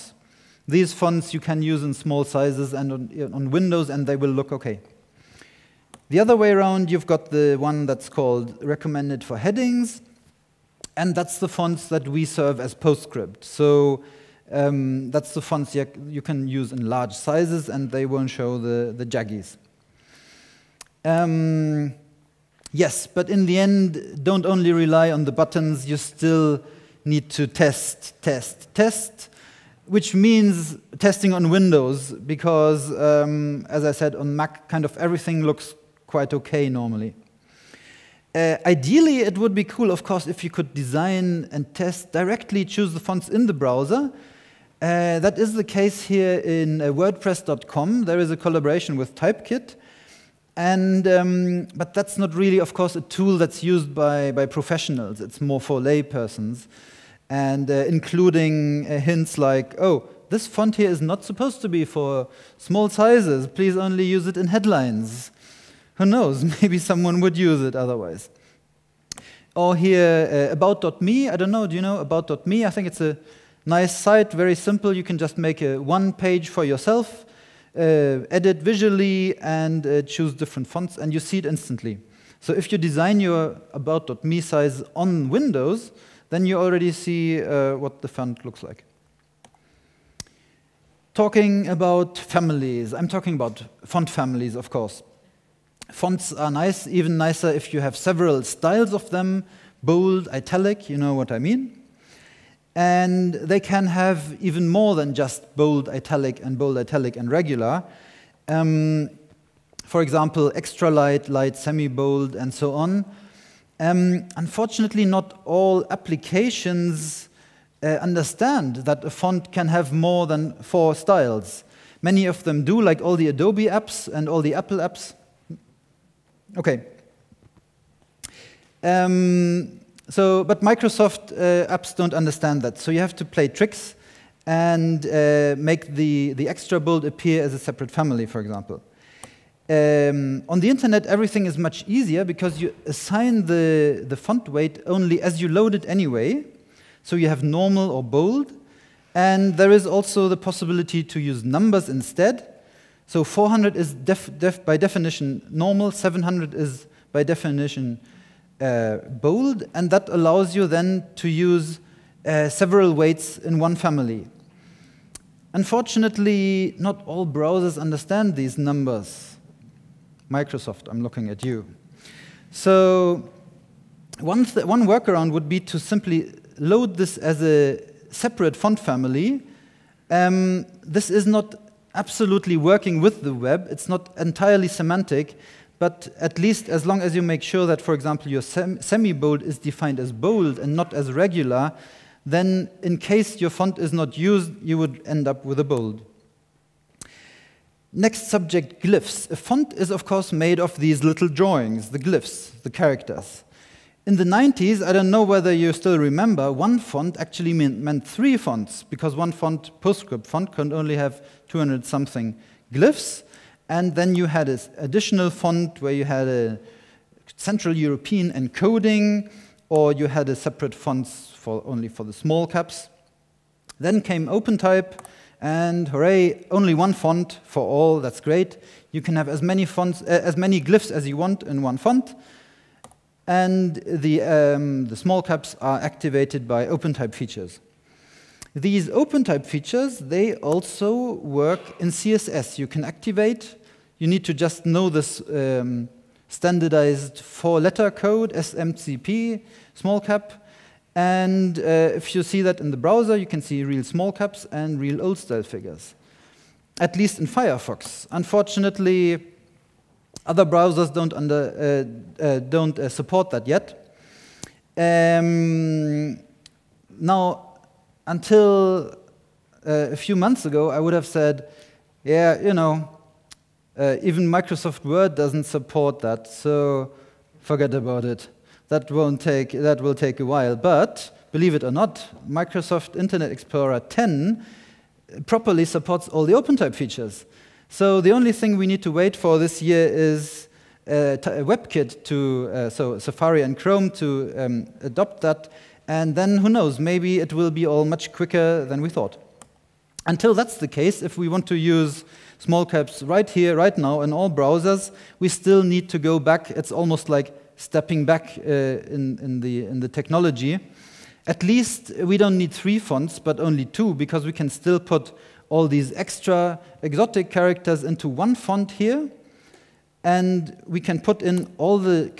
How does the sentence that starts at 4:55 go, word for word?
And then who knows, maybe it will be all much quicker than we thought.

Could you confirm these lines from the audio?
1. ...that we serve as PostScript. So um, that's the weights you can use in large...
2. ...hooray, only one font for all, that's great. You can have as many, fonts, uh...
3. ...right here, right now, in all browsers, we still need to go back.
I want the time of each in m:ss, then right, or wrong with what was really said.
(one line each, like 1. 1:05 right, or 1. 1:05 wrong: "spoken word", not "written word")
1. 0:11 wrong: "fonts", not "weights"
2. 3:45 right
3. 5:03 right.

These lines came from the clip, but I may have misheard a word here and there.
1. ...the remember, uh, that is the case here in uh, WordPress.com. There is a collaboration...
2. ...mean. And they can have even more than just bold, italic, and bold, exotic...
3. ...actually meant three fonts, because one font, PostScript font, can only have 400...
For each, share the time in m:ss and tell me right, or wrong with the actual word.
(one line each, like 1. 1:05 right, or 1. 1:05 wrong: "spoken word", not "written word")
1. 0:43 wrong: "browser", not "remember"
2. 1:41 wrong: "italic", not "exotic"
3. 3:27 wrong: "200", not "400".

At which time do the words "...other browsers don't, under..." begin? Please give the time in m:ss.
4:20.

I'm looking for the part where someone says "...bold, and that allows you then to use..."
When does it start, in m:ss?
2:38.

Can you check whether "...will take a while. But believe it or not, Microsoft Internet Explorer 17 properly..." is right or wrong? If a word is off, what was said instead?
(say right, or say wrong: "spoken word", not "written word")
wrong: "10", not "17".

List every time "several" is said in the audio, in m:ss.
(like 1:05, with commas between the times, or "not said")
1:37, 2:42.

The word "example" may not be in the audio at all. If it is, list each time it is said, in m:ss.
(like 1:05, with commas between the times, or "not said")
1:50, 2:18, 3:07.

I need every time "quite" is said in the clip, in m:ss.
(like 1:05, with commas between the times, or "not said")
0:36.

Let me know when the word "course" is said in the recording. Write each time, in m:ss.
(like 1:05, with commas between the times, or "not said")
0:40, 0:52, 1:34, 3:20.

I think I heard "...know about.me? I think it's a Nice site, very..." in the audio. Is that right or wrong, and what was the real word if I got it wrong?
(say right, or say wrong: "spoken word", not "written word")
right.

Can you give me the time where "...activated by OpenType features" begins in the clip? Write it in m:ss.
3:55.